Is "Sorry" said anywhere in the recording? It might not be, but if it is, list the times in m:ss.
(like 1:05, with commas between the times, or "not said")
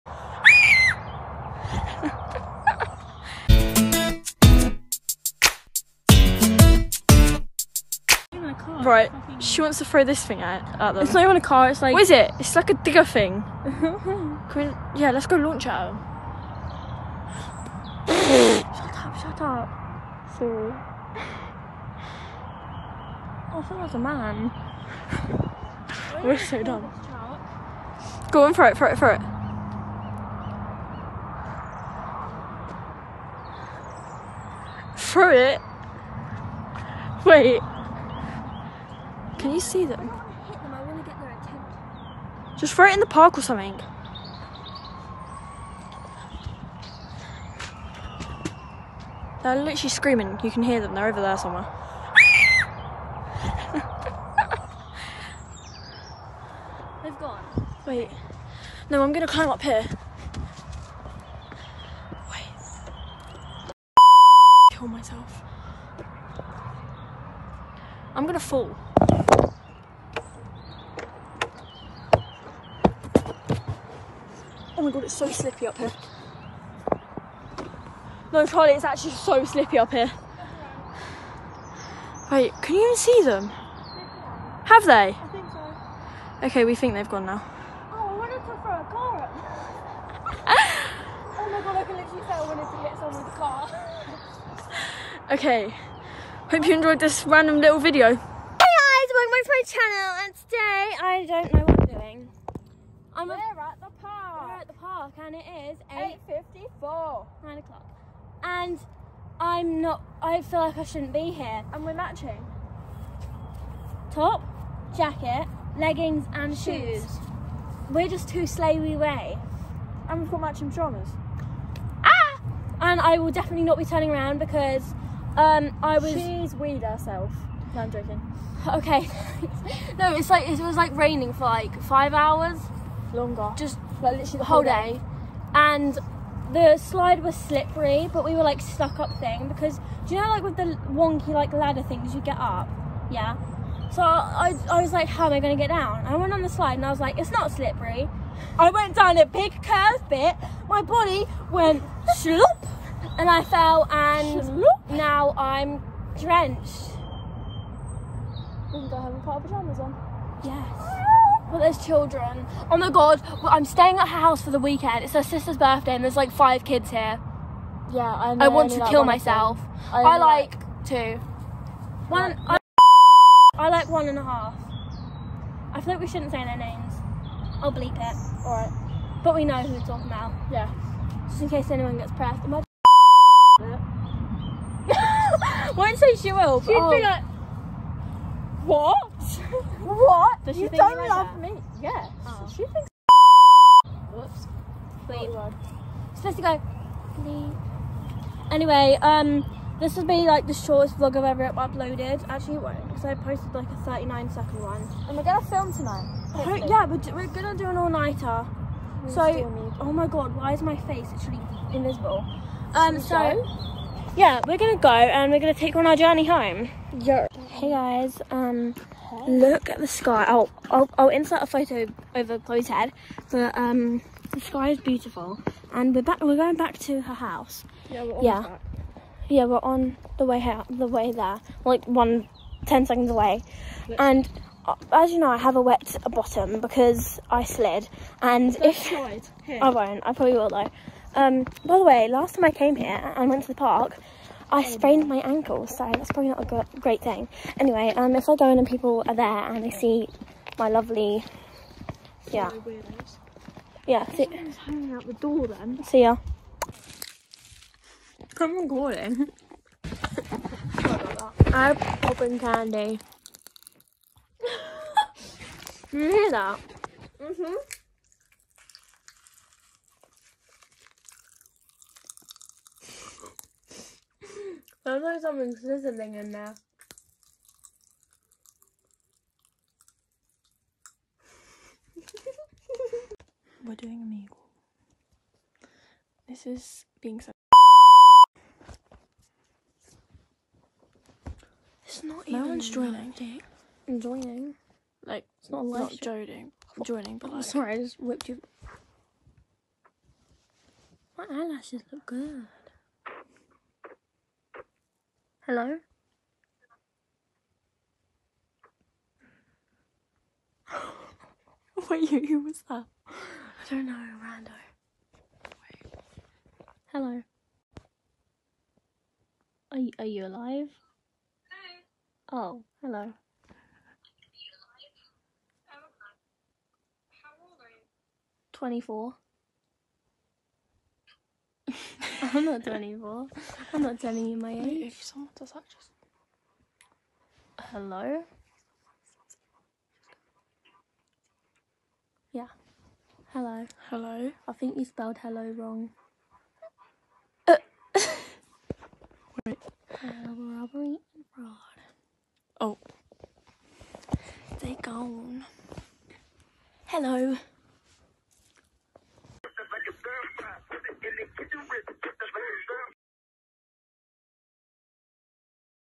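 0:20, 4:57.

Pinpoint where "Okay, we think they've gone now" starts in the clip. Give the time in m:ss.
1:26.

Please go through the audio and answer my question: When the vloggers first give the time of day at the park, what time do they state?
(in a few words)
8.54.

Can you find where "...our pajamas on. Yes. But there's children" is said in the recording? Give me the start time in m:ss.
2:39.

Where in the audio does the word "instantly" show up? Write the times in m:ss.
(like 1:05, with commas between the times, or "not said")
not said.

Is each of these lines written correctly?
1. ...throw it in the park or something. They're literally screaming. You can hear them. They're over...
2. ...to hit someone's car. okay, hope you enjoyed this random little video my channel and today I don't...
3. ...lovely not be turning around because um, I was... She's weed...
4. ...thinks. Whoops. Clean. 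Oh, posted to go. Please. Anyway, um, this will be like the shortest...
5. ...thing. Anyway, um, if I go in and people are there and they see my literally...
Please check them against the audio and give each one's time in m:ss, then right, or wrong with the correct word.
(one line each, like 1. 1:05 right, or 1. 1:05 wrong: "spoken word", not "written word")
1. 0:42 right
2. 1:32 right
3. 2:03 wrong: "definitely", not "lovely"
4. 3:12 wrong: "supposed", not "posted"
5. 4:07 wrong: "lovely", not "literally".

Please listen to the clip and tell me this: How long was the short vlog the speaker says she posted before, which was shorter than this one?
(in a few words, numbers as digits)
39 seconds.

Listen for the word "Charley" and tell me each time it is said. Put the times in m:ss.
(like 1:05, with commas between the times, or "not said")
1:18.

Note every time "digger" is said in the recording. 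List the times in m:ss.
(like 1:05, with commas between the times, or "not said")
0:12.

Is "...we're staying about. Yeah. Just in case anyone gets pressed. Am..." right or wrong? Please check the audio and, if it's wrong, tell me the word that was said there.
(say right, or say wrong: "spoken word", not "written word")
wrong: "talking", not "staying".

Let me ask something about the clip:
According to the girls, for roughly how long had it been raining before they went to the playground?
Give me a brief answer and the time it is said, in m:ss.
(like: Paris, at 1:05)
five hours, at 2:11.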